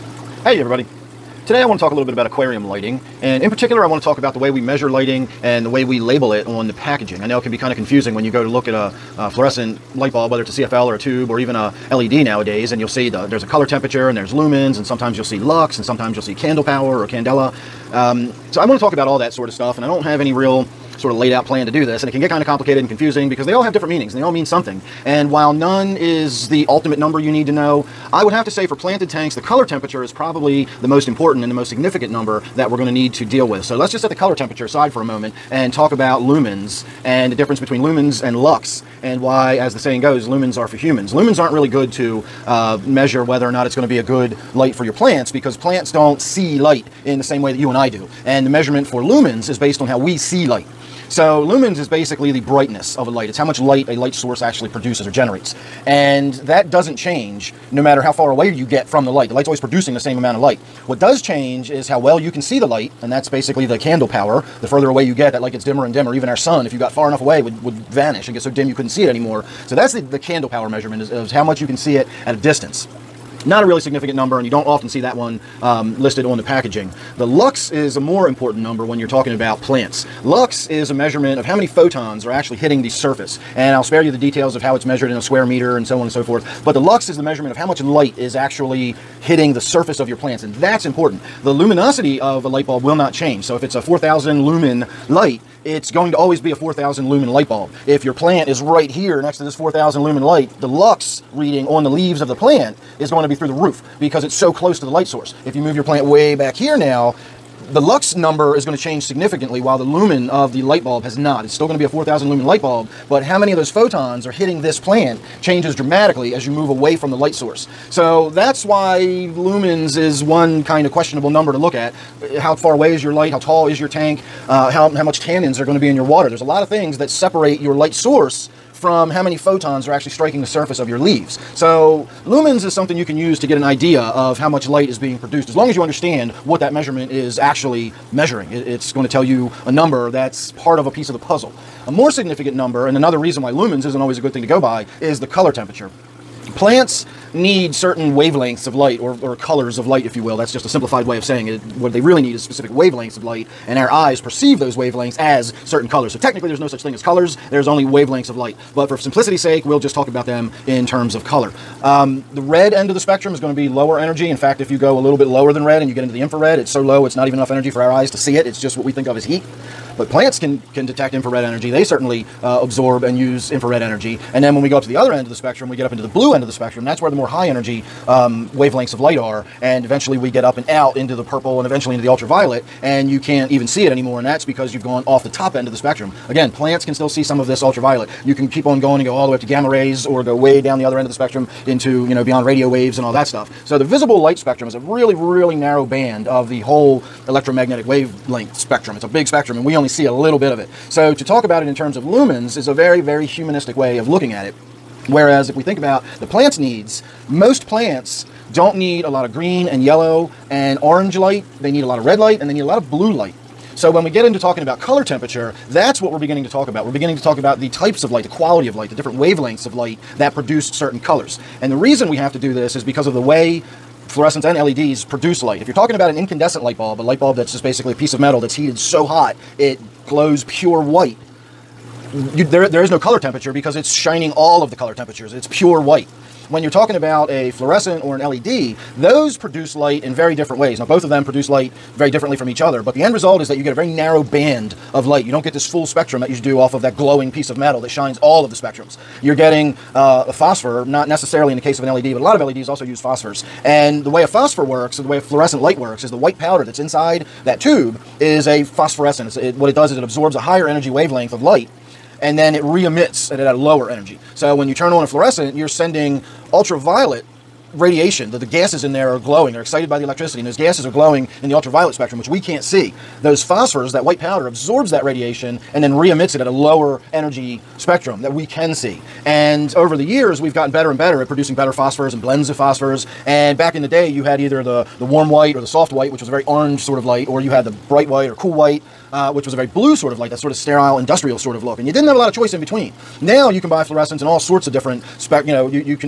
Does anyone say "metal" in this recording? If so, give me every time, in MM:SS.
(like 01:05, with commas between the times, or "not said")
03:48, 04:07.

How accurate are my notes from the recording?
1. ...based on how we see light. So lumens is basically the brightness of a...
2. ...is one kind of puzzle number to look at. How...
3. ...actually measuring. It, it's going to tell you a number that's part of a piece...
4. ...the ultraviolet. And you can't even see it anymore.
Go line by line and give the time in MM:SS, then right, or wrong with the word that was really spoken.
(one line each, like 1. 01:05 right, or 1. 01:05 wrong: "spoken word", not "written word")
1. 00:49 right
2. 01:59 wrong: "questionable", not "puzzle"
3. 02:17 right
4. 03:02 right.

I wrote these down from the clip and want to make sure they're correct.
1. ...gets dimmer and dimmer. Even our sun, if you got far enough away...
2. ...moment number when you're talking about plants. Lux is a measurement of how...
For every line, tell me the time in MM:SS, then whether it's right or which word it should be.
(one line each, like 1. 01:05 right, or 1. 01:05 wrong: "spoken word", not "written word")
1. 01:05 right
2. 01:18 wrong: "important", not "moment".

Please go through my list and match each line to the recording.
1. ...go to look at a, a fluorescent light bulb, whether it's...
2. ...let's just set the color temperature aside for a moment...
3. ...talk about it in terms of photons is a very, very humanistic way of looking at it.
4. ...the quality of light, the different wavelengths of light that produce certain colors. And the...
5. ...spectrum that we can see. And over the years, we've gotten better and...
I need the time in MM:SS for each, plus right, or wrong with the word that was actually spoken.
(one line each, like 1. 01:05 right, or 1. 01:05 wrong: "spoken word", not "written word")
1. 00:08 right
2. 00:33 right
3. 03:21 wrong: "lumens", not "photons"
4. 03:38 right
5. 04:37 right.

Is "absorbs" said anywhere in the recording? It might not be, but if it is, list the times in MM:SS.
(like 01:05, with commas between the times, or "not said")
02:52, 04:20, 04:34.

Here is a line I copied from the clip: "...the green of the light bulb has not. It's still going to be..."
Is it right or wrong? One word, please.
wrong.